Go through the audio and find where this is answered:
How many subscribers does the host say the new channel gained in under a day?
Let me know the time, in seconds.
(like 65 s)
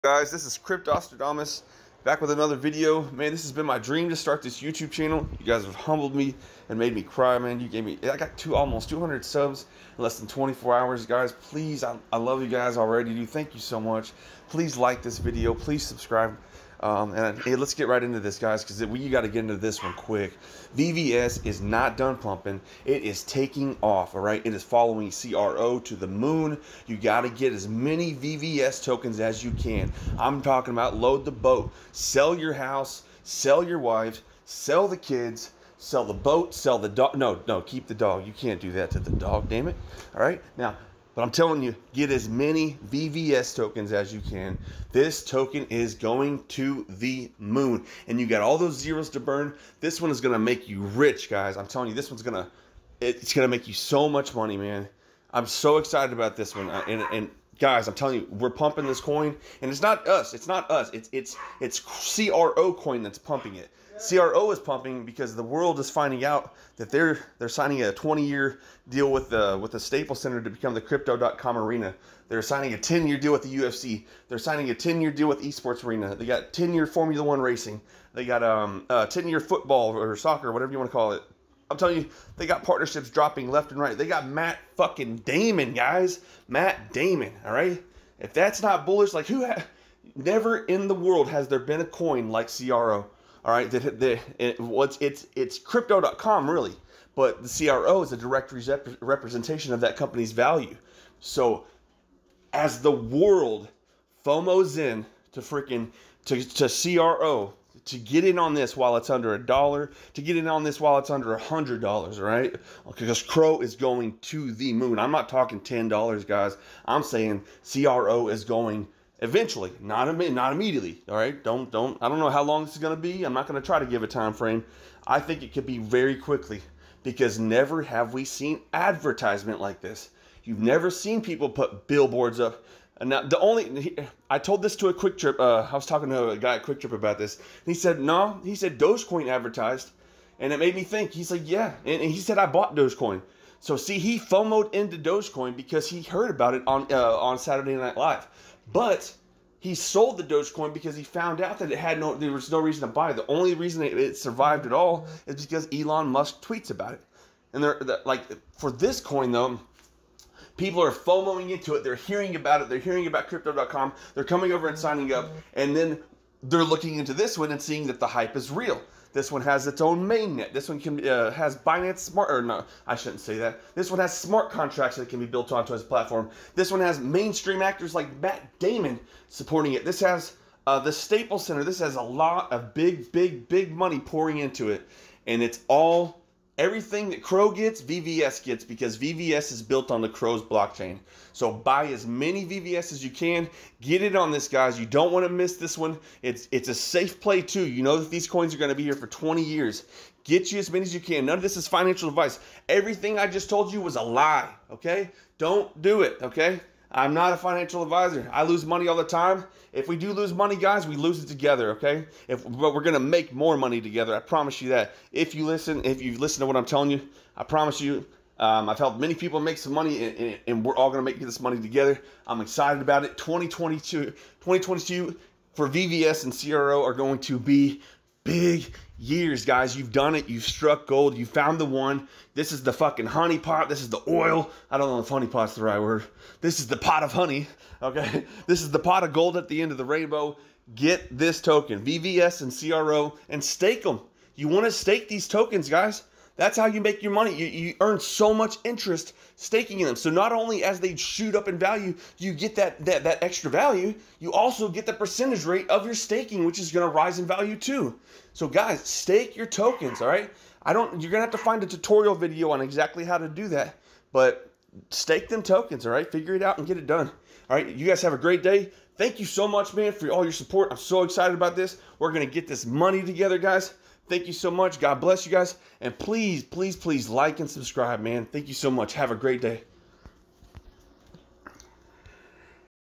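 8 s.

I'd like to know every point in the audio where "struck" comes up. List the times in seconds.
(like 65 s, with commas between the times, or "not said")
230 s.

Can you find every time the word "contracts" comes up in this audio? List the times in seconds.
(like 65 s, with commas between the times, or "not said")
174 s.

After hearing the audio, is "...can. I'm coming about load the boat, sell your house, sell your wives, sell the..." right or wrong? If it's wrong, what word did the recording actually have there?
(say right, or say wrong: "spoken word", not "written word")
wrong: "talking", not "coming".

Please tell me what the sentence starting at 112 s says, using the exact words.
Because CRO is going to the moon.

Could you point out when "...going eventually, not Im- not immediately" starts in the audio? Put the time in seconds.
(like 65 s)
118 s.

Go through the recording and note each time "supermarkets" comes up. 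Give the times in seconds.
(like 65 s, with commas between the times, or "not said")
not said.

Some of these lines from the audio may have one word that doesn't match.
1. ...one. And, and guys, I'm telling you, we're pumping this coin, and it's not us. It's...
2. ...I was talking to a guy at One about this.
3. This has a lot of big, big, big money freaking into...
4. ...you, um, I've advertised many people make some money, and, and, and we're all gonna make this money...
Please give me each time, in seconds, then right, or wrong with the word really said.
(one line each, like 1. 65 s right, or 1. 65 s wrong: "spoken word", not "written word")
1. 56 s right
2. 135 s wrong: "QuikTrip", not "One"
3. 181 s wrong: "pouring", not "freaking"
4. 217 s wrong: "helped", not "advertised".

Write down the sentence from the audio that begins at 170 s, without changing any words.
This one can uh, has Binance Smart, or no, I shouldn't say that.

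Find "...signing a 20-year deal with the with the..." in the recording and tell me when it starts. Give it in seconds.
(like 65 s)
67 s.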